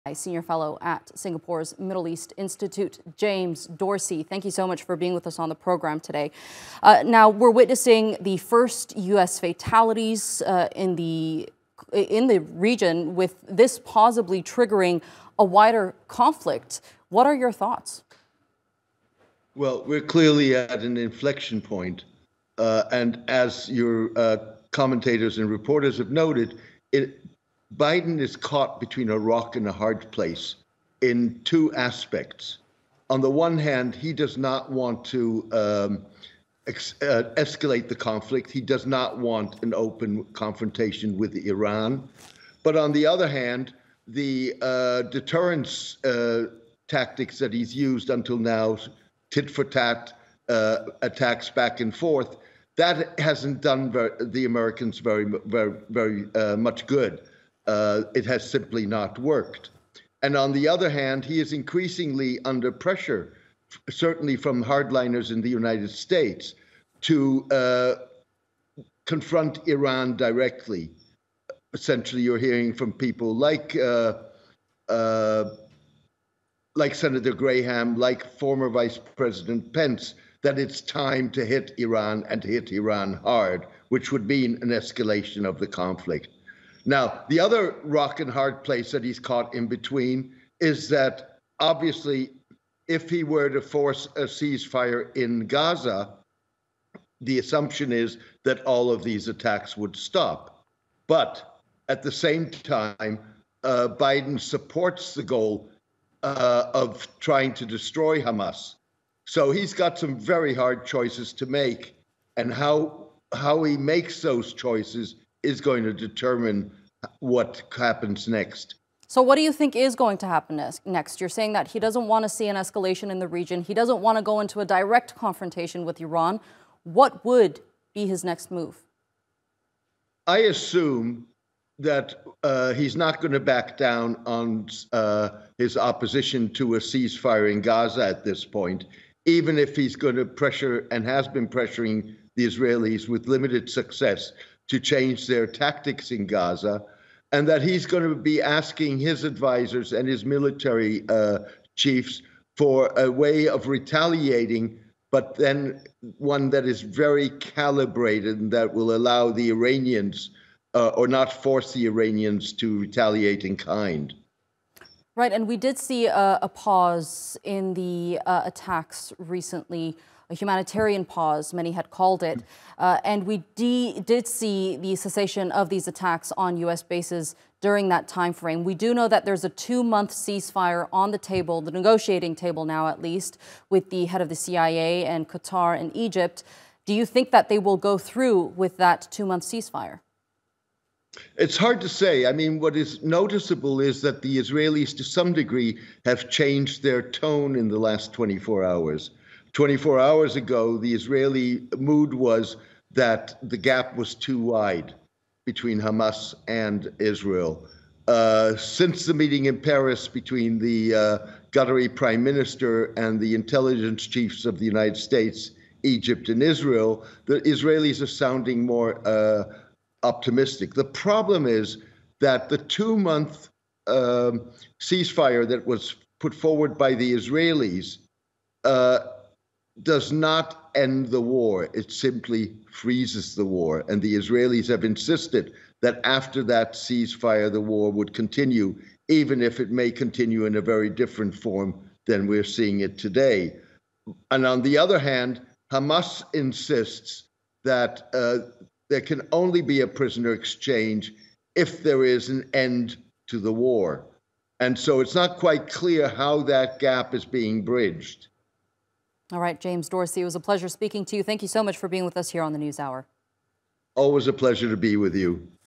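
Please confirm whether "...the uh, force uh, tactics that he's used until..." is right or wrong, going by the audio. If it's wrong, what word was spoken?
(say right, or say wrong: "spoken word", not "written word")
wrong: "deterrence", not "force".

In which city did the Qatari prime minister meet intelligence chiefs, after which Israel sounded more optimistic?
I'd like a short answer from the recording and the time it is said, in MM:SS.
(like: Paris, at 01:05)
Paris, at 03:29.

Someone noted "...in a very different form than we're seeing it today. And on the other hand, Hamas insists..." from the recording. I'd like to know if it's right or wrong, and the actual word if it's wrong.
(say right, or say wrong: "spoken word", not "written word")
right.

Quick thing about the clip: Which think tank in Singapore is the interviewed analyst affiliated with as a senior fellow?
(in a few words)
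Middle East Institute.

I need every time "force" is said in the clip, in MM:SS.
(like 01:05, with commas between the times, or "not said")
01:33, 02:41.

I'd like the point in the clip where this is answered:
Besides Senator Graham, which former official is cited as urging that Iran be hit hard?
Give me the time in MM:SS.
01:19.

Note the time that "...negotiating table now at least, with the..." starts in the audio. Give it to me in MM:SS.
03:01.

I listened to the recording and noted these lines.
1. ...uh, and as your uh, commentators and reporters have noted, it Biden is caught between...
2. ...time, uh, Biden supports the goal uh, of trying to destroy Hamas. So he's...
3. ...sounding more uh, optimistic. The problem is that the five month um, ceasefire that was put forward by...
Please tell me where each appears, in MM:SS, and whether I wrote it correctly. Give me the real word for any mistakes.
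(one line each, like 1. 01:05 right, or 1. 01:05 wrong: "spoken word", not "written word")
1. 00:22 right
2. 01:42 right
3. 03:38 wrong: "two", not "five".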